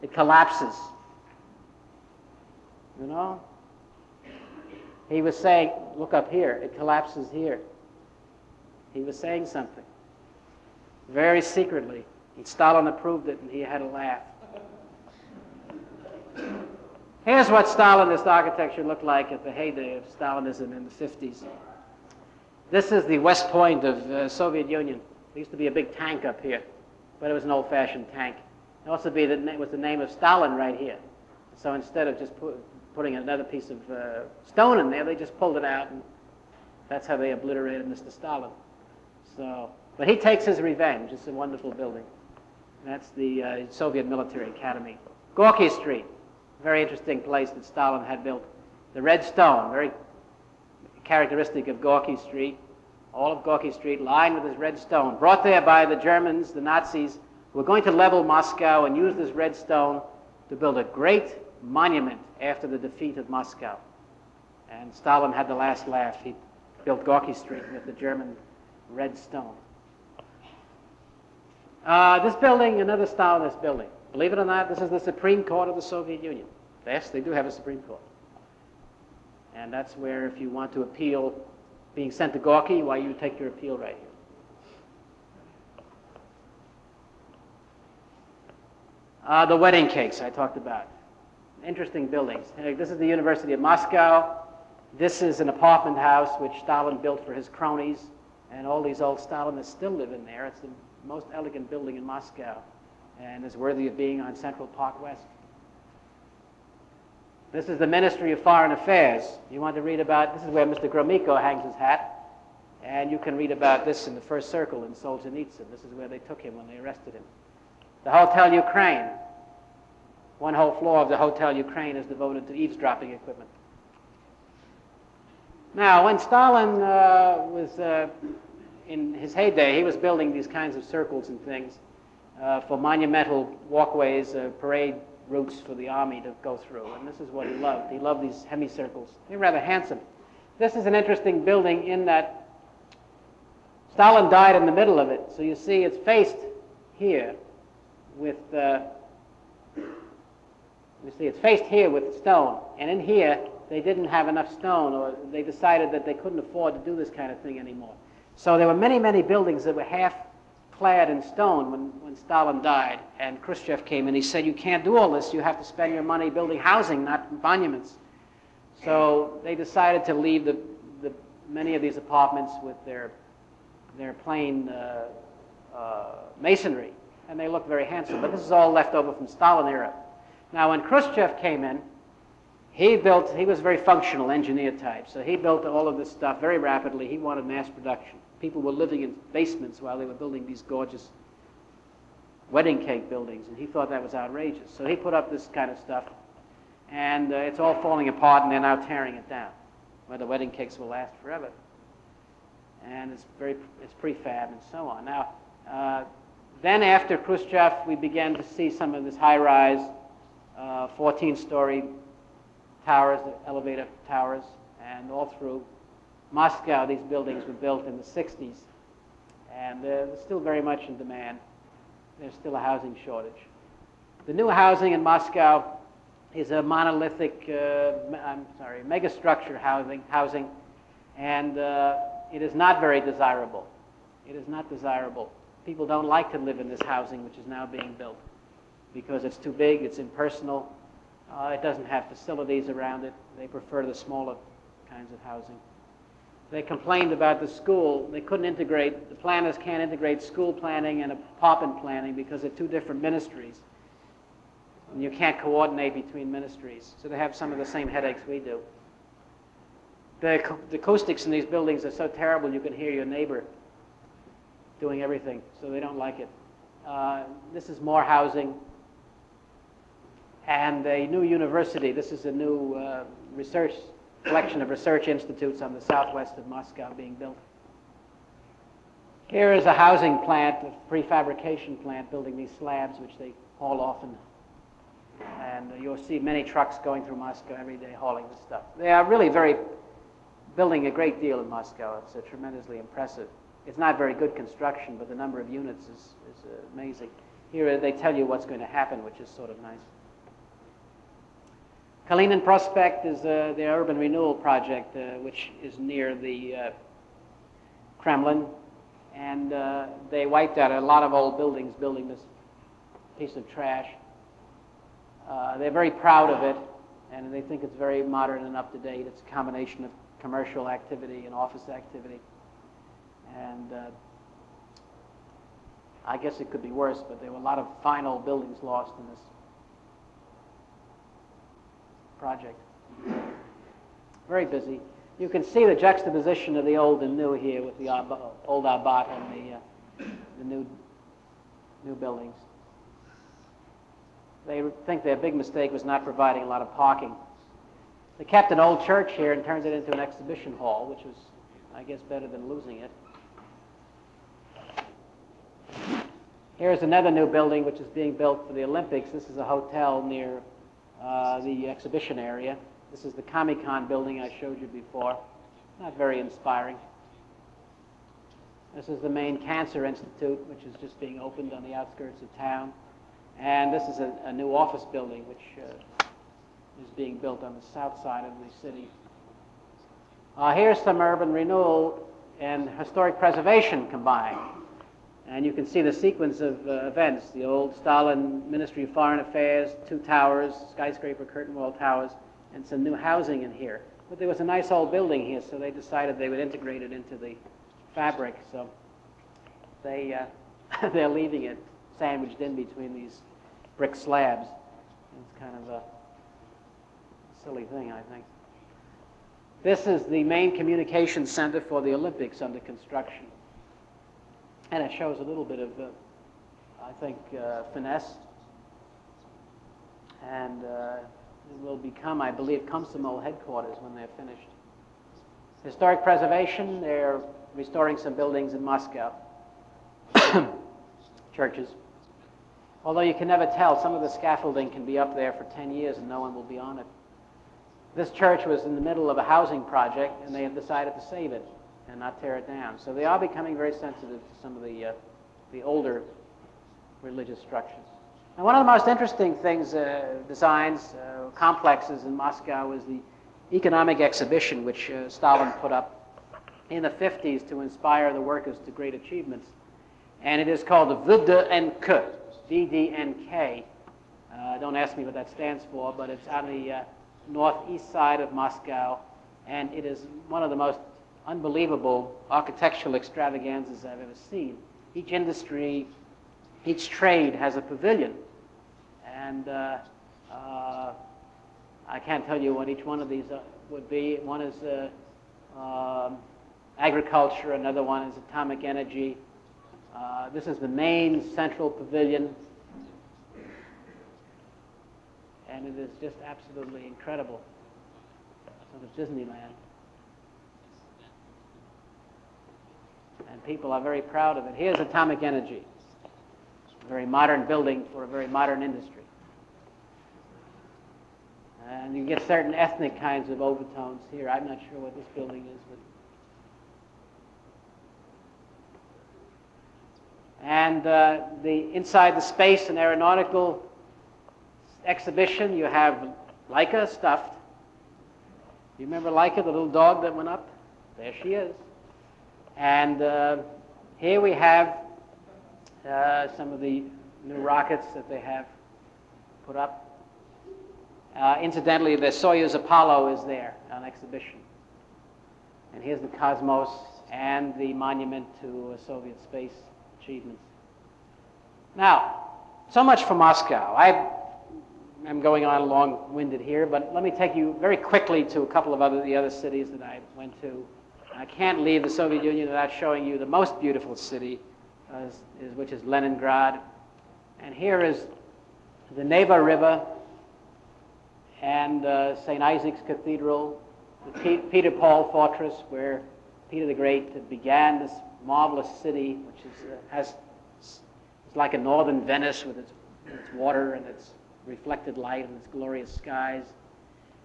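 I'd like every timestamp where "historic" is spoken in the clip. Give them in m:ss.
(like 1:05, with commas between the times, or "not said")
6:22, 7:05.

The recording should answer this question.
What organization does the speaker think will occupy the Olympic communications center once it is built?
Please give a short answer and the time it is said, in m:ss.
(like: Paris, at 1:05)
Komsomol, at 7:02.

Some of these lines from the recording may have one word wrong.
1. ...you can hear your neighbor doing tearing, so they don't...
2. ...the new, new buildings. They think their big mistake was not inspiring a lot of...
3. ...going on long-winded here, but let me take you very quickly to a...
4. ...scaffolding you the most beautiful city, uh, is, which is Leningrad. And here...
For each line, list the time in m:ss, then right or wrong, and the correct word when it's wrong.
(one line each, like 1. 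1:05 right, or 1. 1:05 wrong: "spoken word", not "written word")
1. 4:22 wrong: "everything", not "tearing"
2. 5:40 wrong: "providing", not "inspiring"
3. 9:15 right
4. 9:22 wrong: "showing", not "scaffolding".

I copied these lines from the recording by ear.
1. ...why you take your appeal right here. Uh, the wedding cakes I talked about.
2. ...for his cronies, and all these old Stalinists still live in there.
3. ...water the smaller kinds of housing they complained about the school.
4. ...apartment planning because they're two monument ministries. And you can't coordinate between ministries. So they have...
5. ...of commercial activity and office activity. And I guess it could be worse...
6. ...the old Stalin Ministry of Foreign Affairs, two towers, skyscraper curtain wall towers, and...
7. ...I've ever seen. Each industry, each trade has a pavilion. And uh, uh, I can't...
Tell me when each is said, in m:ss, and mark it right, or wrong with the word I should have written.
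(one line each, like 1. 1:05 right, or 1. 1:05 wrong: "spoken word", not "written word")
1. 1:22 right
2. 1:37 right
3. 4:03 wrong: "prefer", not "water"
4. 4:11 wrong: "different", not "monument"
5. 5:19 right
6. 6:27 right
7. 7:53 right.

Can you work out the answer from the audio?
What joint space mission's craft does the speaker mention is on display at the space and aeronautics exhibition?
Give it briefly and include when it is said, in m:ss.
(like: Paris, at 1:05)
Soyuz Apollo, at 9:02.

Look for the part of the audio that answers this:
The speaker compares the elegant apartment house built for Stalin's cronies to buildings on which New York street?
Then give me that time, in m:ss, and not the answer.
1:44.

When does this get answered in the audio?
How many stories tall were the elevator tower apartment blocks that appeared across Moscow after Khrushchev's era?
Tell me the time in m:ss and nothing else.
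3:30.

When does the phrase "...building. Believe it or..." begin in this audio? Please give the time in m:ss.
1:13.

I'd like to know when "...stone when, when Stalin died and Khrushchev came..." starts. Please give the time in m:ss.
2:41.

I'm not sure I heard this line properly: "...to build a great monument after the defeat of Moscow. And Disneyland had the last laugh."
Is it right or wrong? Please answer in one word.
wrong.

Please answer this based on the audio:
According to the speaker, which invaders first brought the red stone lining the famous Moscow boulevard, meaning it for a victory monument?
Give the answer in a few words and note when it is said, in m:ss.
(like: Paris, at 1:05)
The Nazis, at 0:56.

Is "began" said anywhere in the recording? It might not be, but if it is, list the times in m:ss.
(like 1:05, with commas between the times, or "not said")
3:27, 9:37.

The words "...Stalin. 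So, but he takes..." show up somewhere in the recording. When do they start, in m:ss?
0:38.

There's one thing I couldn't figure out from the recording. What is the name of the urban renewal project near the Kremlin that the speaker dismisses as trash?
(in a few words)
Kalinin Prospect.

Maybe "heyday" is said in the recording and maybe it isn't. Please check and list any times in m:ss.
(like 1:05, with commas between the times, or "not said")
0:19, 2:09.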